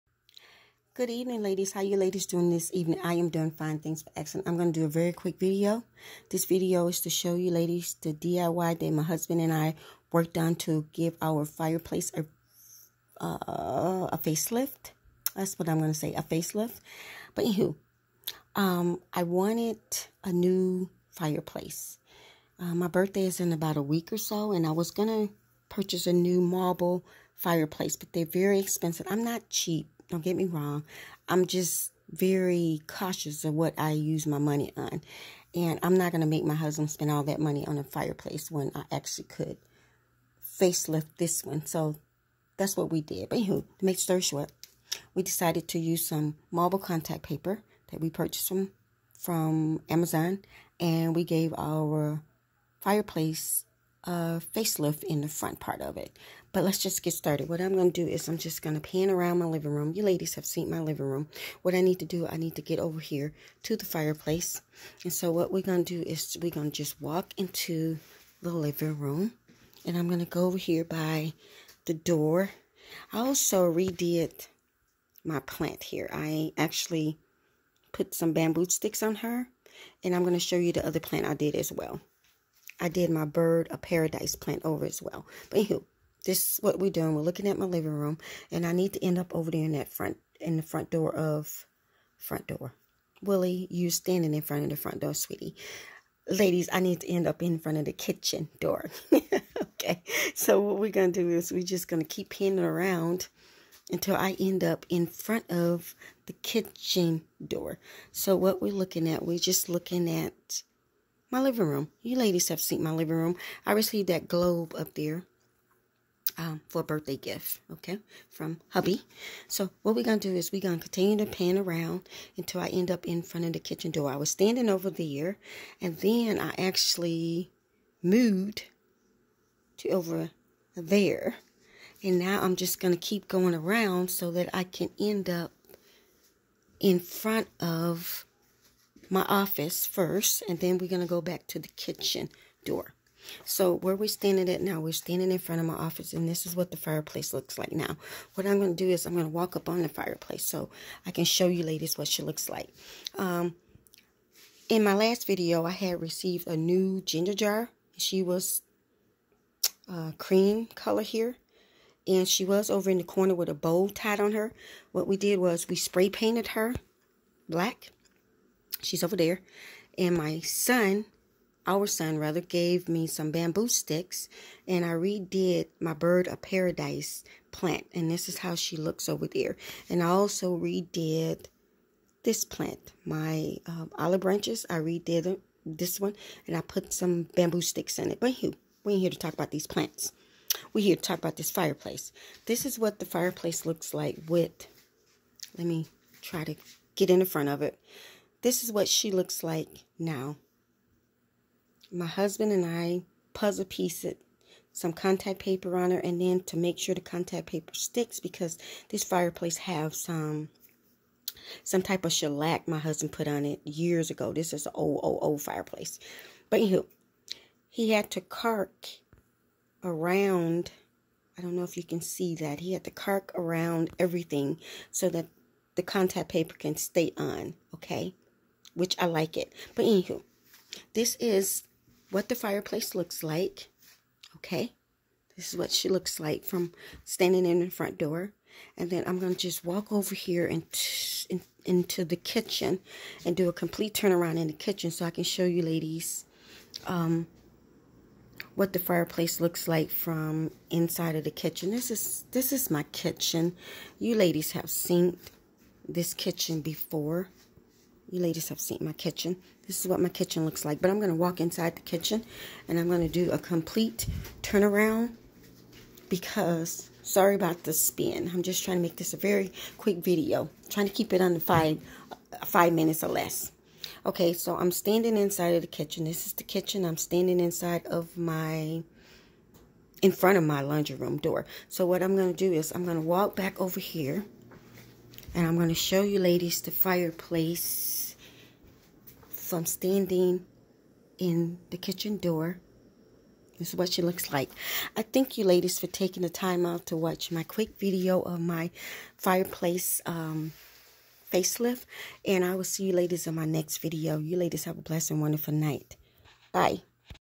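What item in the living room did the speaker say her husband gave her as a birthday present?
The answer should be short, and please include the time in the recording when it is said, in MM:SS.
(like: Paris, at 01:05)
globe, at 01:54.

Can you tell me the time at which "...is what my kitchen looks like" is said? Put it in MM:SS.
04:19.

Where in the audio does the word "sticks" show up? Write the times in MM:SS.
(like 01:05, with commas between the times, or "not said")
01:18, 02:53, 03:07, 03:27.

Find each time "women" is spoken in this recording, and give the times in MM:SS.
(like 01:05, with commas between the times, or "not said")
not said.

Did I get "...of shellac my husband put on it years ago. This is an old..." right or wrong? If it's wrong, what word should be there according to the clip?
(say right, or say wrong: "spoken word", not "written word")
right.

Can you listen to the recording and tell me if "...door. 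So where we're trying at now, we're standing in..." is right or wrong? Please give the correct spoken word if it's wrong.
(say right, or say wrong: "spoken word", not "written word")
wrong: "standing", not "trying".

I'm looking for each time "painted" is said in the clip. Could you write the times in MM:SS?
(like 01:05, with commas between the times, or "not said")
02:46.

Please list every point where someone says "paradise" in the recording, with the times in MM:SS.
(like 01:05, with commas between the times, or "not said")
01:23, 02:56.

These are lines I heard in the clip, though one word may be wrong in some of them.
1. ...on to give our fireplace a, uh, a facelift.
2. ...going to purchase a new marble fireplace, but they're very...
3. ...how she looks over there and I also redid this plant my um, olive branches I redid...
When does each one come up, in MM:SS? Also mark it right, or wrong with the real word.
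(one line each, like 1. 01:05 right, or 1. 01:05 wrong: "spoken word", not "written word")
1. 00:10 right
2. 00:24 right
3. 02:58 right.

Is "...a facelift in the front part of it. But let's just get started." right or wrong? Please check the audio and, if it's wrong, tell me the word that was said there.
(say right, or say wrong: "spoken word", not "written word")
right.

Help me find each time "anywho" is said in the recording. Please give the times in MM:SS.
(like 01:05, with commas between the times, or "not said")
00:17, 00:43, 01:25, 03:36, 03:49.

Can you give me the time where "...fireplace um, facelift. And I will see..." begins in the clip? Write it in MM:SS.
04:59.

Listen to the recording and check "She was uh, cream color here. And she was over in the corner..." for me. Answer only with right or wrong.
right.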